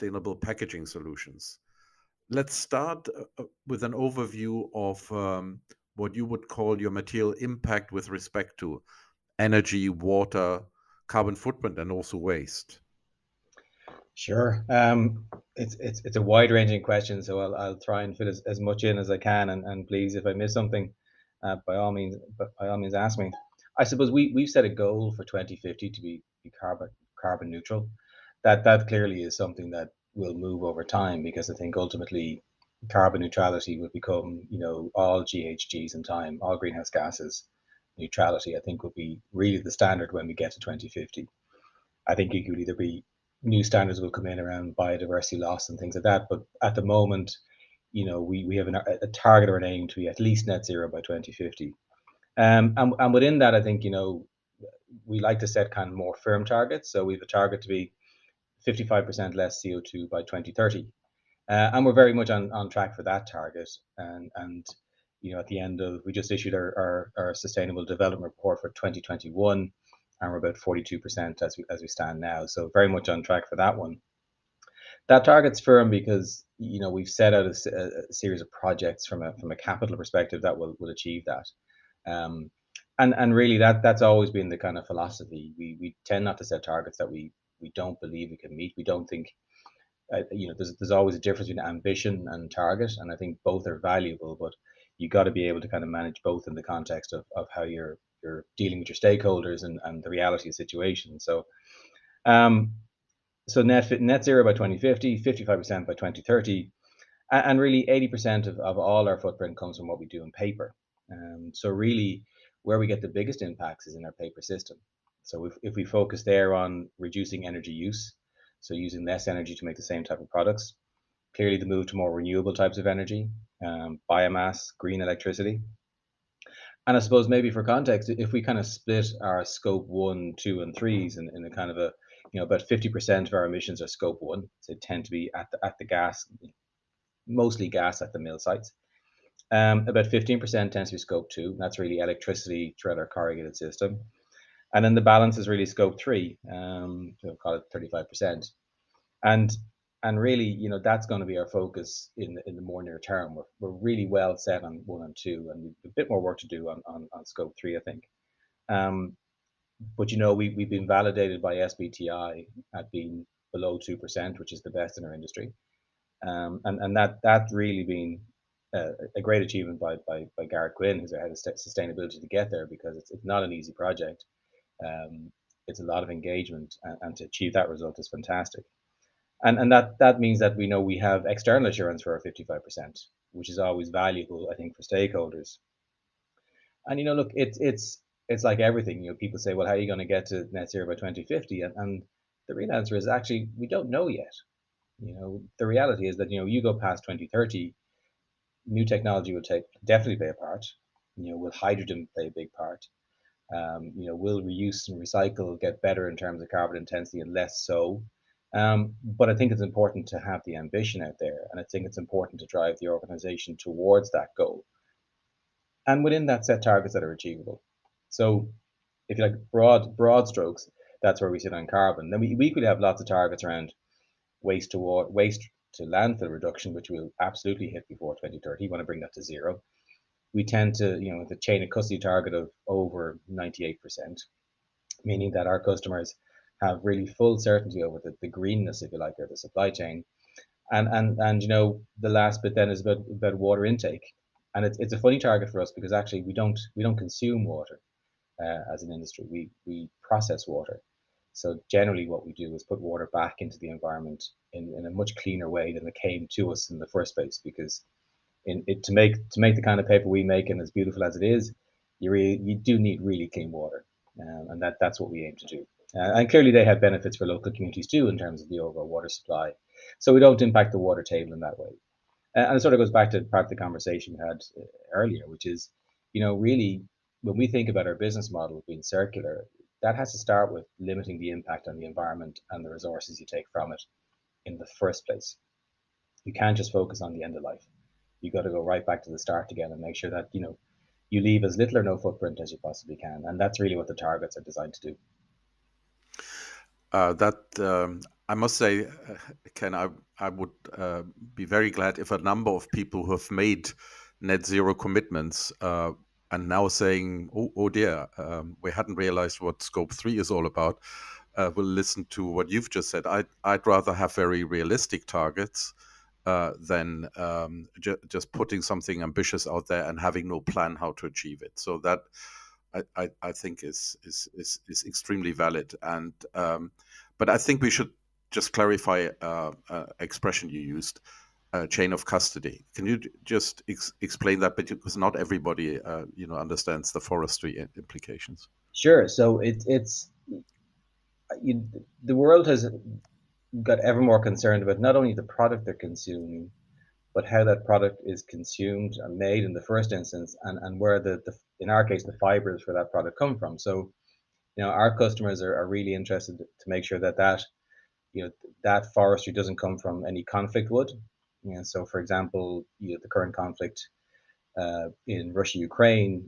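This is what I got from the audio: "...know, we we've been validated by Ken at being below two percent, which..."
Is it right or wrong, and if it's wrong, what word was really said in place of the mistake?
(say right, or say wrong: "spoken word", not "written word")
wrong: "SBTI", not "Ken".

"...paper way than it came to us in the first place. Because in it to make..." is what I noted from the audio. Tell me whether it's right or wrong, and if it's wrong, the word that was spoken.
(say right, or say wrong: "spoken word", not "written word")
wrong: "cleaner", not "paper".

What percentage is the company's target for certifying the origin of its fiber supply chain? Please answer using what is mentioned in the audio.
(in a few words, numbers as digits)
over 98%.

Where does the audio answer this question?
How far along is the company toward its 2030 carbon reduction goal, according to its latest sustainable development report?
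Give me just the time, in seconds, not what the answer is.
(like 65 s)
70 s.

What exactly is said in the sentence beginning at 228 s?
We want to bring that to zero.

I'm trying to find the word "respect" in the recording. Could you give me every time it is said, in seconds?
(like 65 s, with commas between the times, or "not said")
8 s.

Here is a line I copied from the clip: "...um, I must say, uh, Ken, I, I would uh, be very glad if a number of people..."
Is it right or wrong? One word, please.
right.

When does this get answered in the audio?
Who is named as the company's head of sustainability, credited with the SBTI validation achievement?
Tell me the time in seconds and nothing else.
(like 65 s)
170 s.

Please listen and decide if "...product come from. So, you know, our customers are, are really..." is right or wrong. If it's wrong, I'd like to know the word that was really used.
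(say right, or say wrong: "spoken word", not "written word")
right.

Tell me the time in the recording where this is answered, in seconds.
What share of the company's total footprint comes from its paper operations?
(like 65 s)
107 s.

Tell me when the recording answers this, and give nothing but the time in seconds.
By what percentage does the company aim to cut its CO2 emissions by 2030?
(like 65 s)
58 s.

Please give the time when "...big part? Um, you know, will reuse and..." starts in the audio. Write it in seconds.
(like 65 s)
202 s.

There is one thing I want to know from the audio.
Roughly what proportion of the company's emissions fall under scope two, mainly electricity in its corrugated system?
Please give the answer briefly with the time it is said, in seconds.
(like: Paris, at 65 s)
15%, at 140 s.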